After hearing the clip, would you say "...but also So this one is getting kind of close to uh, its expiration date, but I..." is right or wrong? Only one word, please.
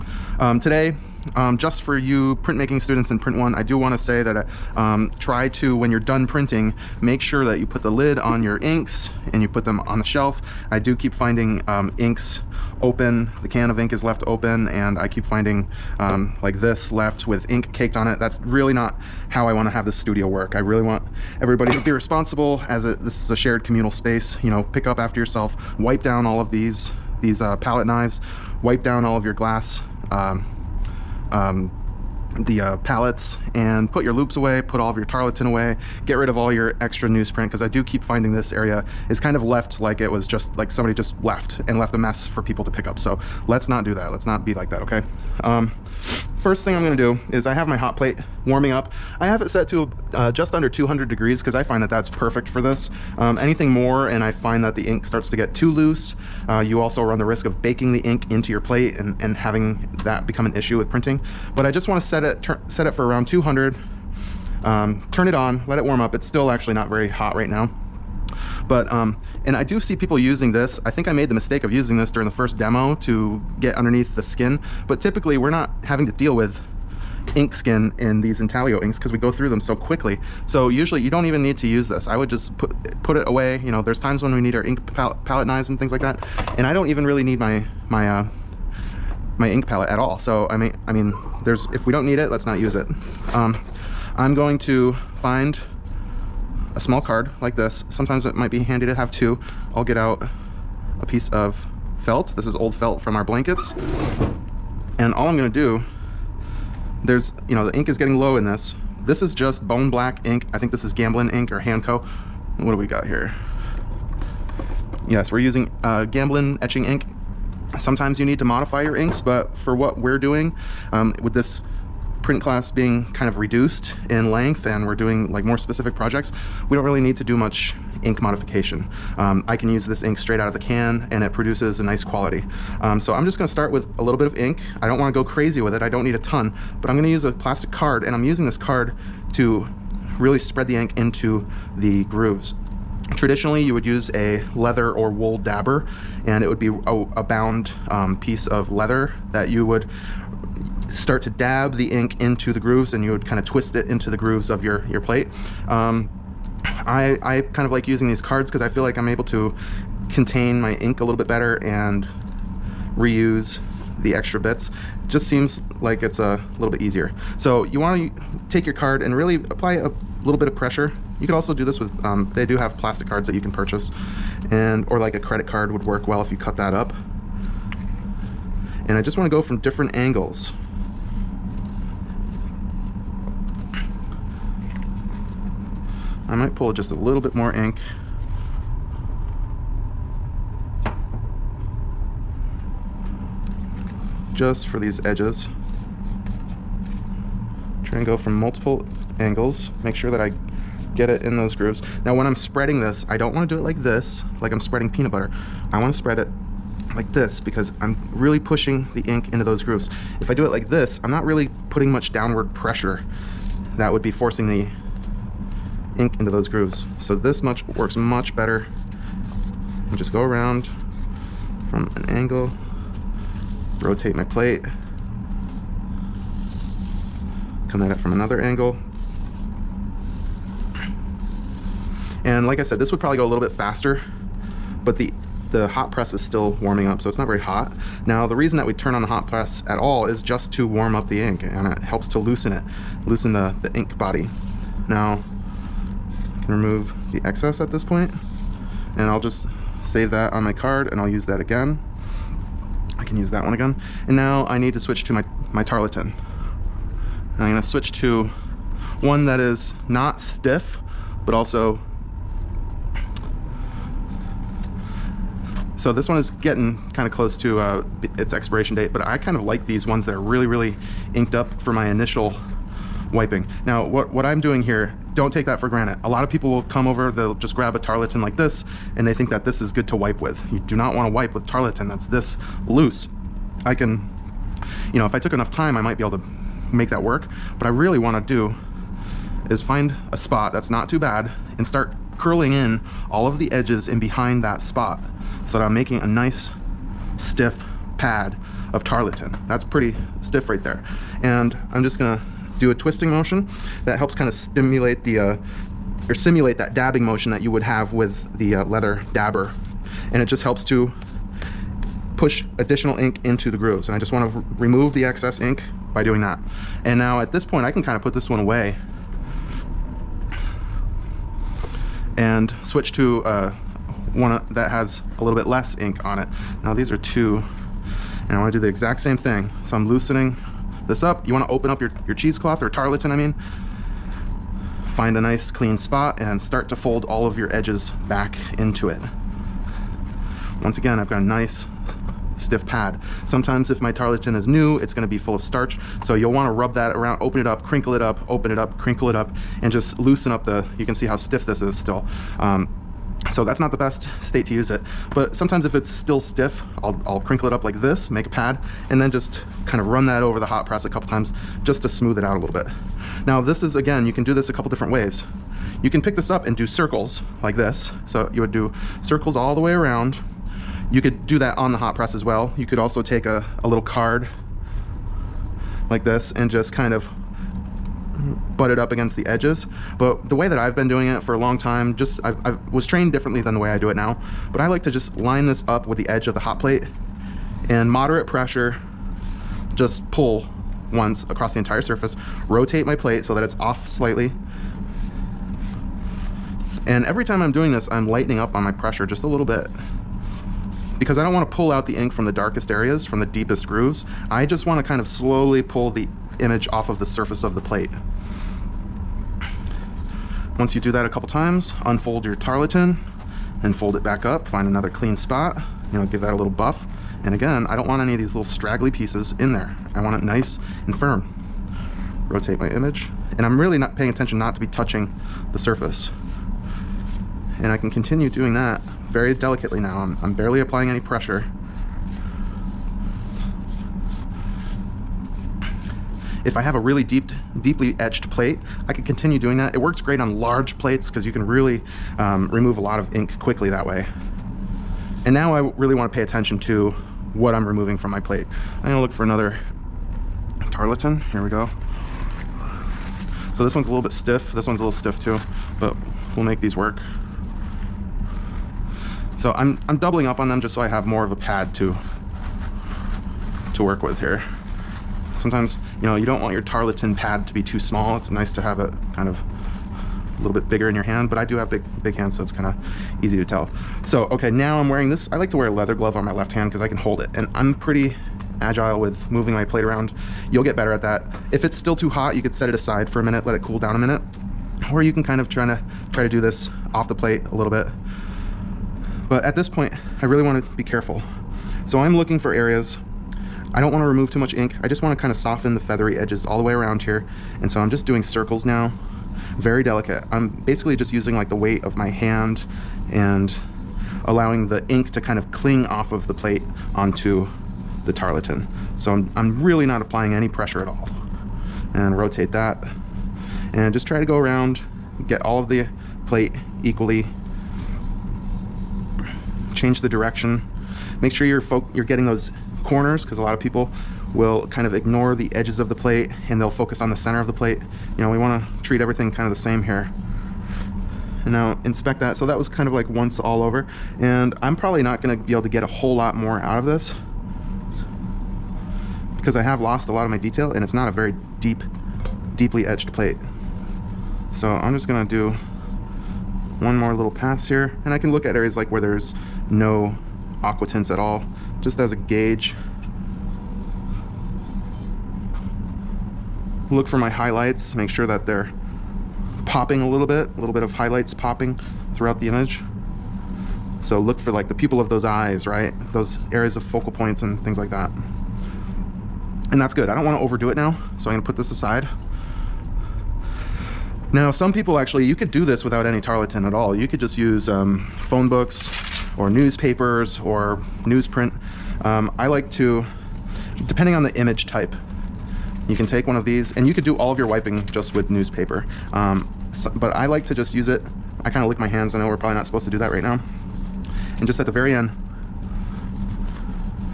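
right.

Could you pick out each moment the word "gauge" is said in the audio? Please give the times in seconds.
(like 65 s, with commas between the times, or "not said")
552 s.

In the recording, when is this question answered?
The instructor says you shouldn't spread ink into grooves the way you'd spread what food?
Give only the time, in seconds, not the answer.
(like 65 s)
204 s.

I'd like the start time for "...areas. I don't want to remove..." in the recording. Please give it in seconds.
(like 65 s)
492 s.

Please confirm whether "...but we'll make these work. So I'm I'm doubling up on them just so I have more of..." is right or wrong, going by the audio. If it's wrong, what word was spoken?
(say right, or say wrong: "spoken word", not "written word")
right.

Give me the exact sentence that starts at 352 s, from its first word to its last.
Um, so that's not the best state to use it.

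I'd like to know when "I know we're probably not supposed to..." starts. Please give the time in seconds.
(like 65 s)
592 s.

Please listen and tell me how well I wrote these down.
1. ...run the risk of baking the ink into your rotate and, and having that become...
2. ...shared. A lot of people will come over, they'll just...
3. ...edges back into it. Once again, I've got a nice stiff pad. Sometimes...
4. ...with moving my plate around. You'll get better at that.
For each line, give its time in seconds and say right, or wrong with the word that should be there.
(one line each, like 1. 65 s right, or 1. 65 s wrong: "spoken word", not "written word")
1. 57 s wrong: "plate", not "rotate"
2. 275 s wrong: "granted", not "shared"
3. 337 s right
4. 478 s right.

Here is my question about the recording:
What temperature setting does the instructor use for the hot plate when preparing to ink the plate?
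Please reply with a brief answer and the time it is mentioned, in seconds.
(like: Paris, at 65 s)
just under 200 degrees, at 50 s.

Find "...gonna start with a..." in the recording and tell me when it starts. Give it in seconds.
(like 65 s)
133 s.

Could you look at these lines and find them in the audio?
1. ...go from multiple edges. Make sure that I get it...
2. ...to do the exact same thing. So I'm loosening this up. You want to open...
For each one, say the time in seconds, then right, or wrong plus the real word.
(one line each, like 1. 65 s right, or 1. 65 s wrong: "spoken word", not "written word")
1. 198 s wrong: "angles", not "edges"
2. 328 s right.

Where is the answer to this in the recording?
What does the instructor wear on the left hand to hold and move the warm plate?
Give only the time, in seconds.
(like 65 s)
475 s.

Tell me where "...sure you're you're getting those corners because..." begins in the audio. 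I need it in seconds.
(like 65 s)
521 s.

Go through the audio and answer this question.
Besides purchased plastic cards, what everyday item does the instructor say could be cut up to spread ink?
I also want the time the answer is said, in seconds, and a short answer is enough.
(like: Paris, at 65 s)
a credit card, at 175 s.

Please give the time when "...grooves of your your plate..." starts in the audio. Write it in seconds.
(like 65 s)
154 s.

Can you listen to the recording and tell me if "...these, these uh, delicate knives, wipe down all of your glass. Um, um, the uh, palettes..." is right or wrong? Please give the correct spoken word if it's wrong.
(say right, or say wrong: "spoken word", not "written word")
wrong: "palette", not "delicate".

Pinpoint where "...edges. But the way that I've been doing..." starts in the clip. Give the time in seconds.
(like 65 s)
379 s.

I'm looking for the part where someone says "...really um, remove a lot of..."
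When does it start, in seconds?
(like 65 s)
441 s.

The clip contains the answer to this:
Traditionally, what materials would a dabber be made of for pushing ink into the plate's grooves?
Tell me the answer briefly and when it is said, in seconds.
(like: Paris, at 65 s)
leather or wool, at 144 s.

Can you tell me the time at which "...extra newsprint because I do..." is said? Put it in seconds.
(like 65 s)
36 s.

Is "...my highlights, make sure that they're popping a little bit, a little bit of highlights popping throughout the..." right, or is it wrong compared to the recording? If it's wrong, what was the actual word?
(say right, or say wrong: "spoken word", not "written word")
right.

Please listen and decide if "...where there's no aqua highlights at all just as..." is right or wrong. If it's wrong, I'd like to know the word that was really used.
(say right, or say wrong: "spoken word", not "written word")
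wrong: "tints", not "highlights".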